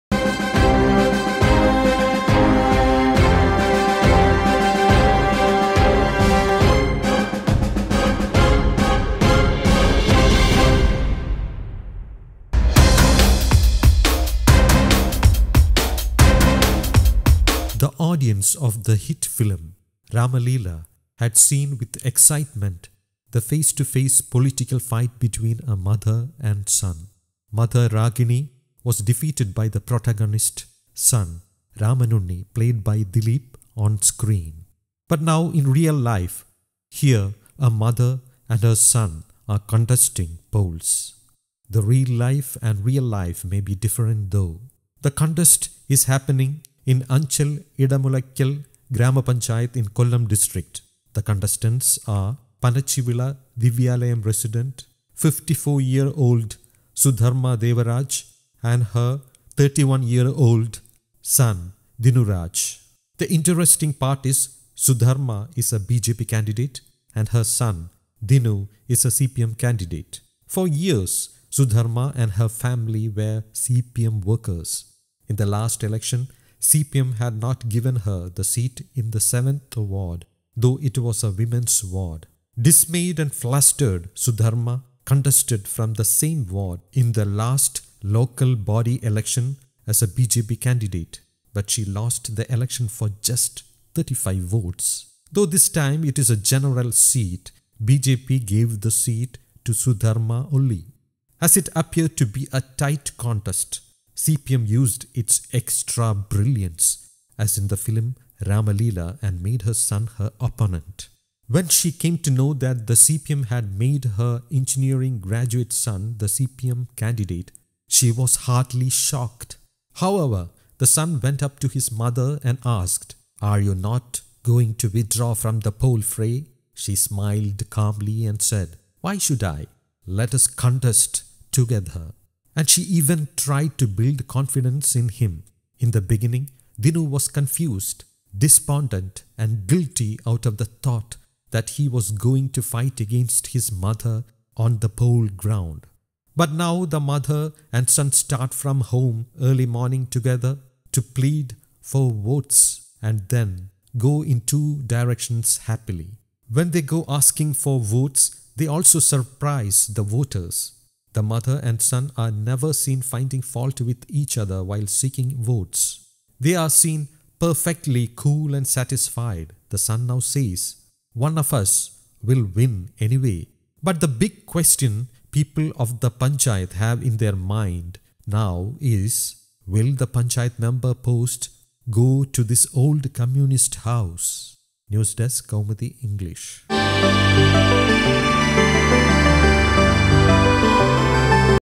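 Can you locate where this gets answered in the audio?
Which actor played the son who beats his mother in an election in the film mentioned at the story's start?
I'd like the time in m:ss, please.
0:33.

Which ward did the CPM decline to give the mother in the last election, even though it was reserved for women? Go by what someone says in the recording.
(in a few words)
7th ward.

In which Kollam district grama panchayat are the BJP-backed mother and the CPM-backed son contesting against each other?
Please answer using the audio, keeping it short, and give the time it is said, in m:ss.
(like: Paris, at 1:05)
Anchal Idamulakkal, at 0:47.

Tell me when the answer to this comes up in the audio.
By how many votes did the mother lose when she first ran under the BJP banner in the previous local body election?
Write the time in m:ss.
1:33.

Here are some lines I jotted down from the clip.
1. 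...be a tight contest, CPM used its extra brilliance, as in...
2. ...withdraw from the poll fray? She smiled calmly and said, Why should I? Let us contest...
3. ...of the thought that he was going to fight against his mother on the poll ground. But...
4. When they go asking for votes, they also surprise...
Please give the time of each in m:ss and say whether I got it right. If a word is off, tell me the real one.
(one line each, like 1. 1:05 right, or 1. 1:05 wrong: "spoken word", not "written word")
1. 1:42 right
2. 2:04 right
3. 2:20 right
4. 2:36 right.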